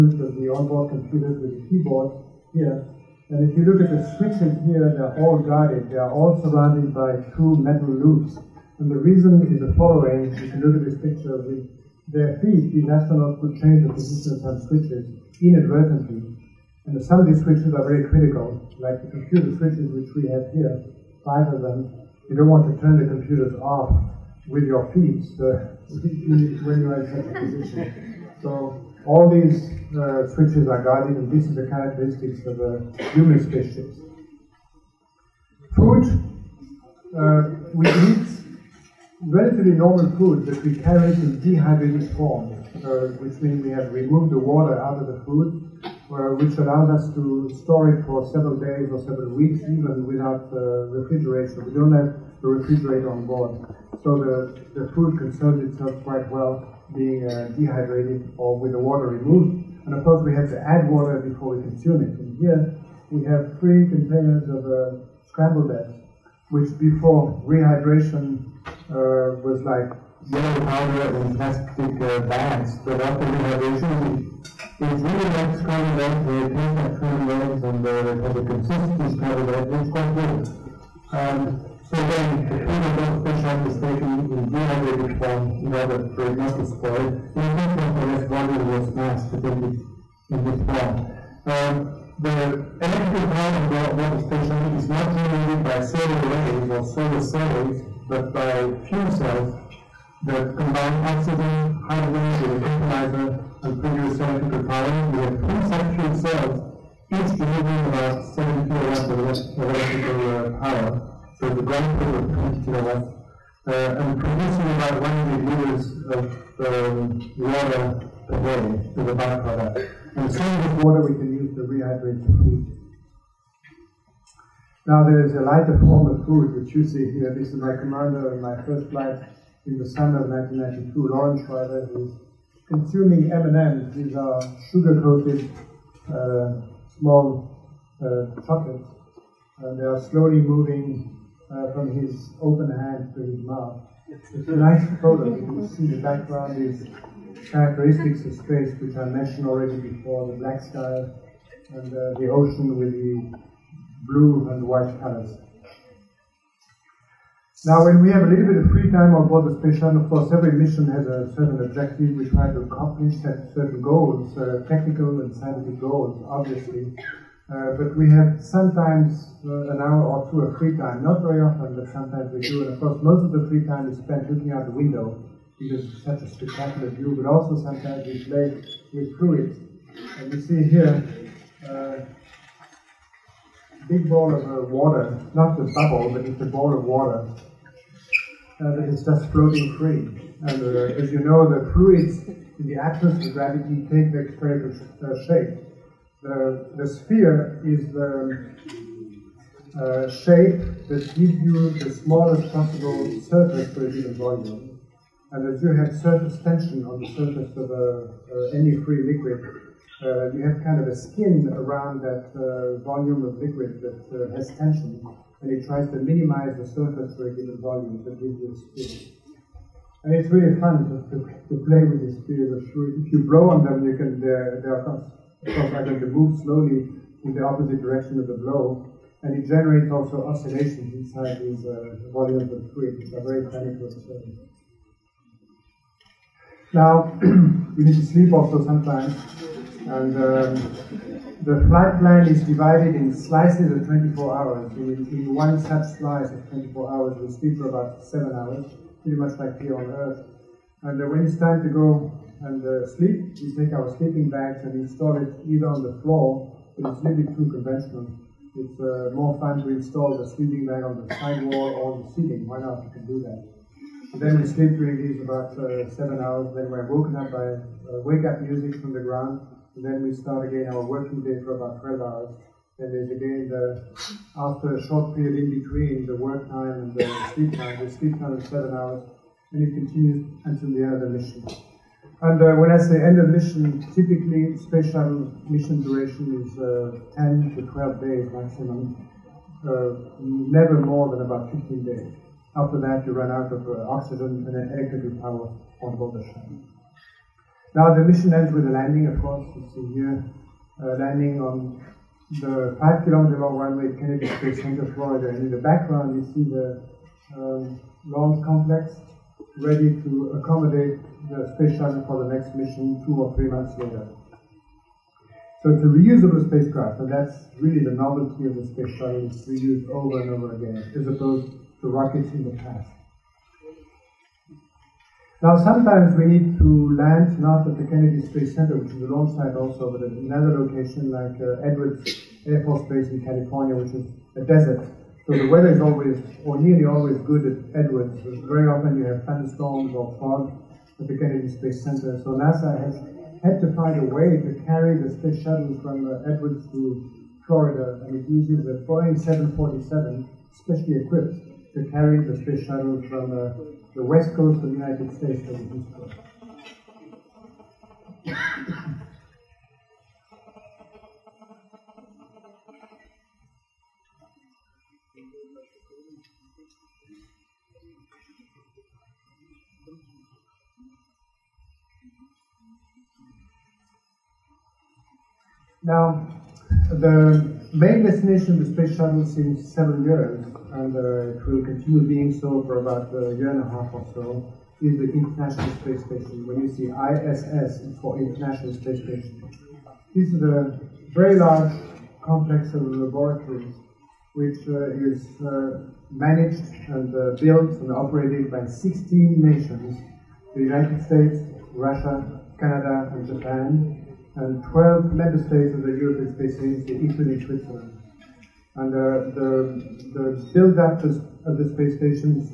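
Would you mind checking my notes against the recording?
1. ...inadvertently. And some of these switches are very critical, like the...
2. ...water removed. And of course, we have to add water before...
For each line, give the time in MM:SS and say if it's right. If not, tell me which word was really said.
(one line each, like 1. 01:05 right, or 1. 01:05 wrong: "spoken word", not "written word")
1. 00:15 right
2. 00:58 right.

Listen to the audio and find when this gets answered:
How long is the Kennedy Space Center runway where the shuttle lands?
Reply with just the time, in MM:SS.
05:02.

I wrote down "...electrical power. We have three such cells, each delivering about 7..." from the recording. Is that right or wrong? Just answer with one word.
right.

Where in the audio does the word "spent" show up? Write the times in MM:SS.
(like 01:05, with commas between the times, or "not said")
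02:54.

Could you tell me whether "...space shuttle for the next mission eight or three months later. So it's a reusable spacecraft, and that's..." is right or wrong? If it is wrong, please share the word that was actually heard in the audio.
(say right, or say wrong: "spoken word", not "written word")
wrong: "two", not "eight".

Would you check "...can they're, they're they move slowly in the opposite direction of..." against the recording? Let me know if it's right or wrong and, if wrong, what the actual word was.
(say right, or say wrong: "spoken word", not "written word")
right.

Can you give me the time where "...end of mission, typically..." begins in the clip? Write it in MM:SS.
04:43.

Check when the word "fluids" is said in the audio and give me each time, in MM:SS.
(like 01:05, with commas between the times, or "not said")
02:59, 03:11, 03:52.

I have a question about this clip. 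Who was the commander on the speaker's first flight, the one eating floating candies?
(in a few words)
Loren Shriver.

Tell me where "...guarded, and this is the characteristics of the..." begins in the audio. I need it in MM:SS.
00:30.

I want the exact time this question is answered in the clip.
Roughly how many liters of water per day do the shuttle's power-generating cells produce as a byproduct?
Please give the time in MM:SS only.
01:55.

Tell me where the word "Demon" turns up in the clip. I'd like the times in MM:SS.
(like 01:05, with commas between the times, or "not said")
not said.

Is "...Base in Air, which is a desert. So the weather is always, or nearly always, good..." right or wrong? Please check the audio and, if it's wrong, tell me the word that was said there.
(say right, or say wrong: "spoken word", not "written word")
wrong: "California", not "Air".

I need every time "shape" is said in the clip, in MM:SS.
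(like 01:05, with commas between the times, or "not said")
03:15, 03:20.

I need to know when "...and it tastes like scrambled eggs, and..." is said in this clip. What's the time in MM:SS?
01:16.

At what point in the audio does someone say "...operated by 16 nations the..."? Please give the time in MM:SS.
06:37.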